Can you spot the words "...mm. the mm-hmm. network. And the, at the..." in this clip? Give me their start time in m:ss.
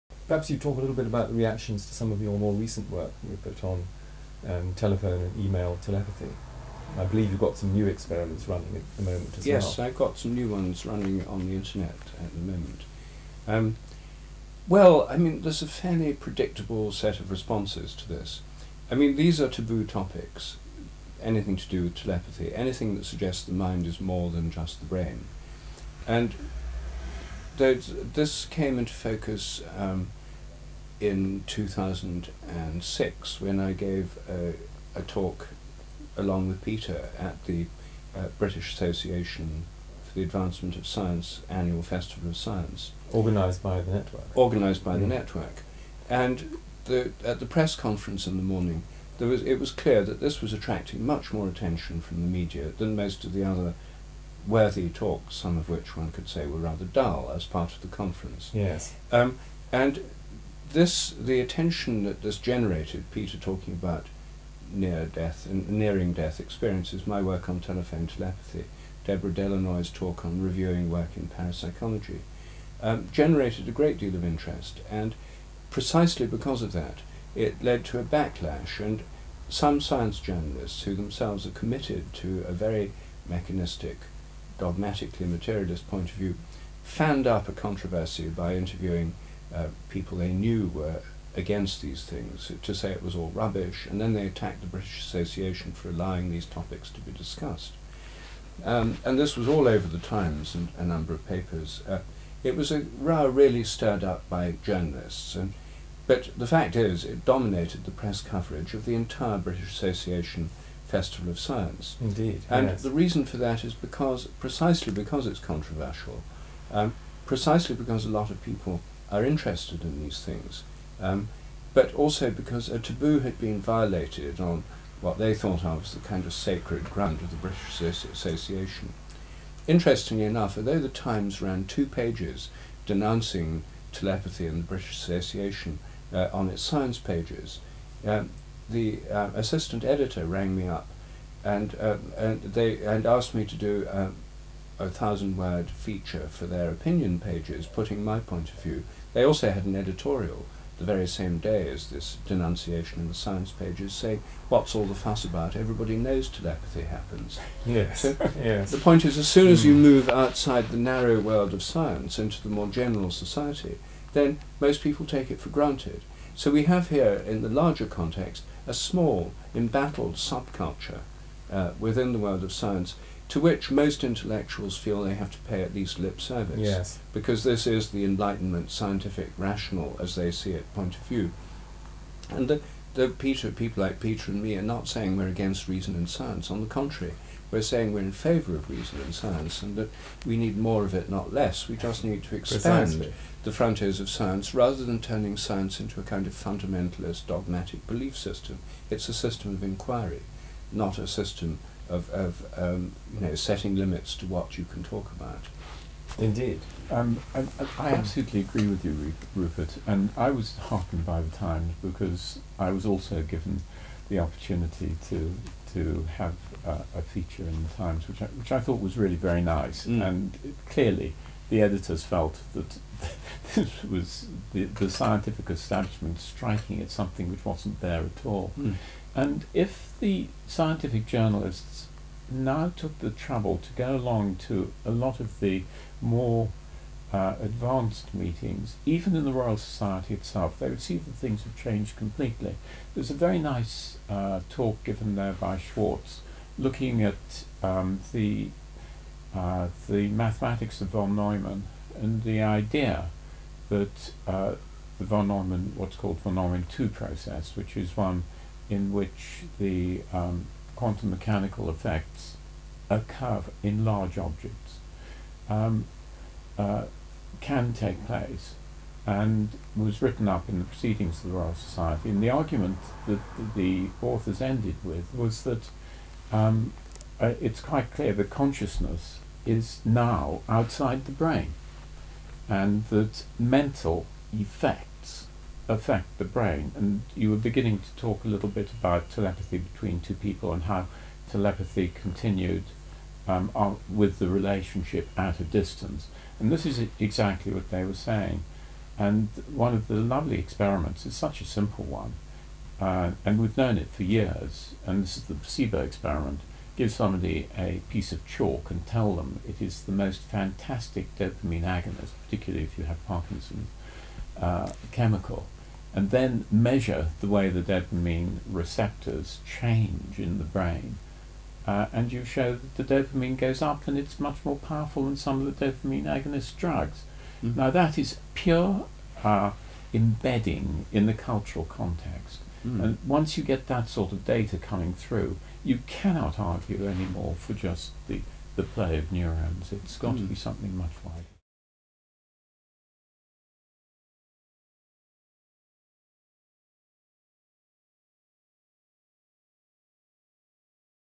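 0:44.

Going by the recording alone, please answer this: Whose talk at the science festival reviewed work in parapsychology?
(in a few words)
Deborah Delanoy.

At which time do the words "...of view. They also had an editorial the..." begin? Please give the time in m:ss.
2:28.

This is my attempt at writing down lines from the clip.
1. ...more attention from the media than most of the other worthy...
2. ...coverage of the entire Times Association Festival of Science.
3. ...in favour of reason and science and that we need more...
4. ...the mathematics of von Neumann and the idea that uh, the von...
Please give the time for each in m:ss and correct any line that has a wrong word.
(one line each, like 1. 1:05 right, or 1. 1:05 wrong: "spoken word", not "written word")
1. 0:51 right
2. 1:48 wrong: "British", not "Times"
3. 3:08 right
4. 4:09 right.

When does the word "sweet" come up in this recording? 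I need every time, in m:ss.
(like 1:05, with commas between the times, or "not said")
not said.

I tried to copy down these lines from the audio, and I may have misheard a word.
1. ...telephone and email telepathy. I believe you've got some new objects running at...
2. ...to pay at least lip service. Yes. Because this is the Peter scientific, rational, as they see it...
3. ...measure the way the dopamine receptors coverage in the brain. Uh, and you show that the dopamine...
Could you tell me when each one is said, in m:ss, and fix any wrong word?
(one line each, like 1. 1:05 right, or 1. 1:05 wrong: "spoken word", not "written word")
1. 0:04 wrong: "experiments", not "objects"
2. 2:55 wrong: "Enlightenment", not "Peter"
3. 5:16 wrong: "change", not "coverage".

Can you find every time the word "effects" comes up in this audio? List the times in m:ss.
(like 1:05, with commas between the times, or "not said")
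4:21, 4:44.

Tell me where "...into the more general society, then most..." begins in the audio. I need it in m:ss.
2:42.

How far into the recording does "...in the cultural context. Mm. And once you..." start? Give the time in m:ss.
5:30.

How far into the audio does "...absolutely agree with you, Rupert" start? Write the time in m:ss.
3:27.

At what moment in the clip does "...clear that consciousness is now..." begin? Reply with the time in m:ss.
4:37.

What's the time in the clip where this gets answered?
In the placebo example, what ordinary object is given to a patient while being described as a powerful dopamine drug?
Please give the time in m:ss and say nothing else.
5:08.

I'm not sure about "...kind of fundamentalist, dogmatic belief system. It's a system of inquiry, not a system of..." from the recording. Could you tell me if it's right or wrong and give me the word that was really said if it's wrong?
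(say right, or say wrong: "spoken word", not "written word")
right.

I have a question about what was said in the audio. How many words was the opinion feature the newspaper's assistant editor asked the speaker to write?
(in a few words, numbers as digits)
1000.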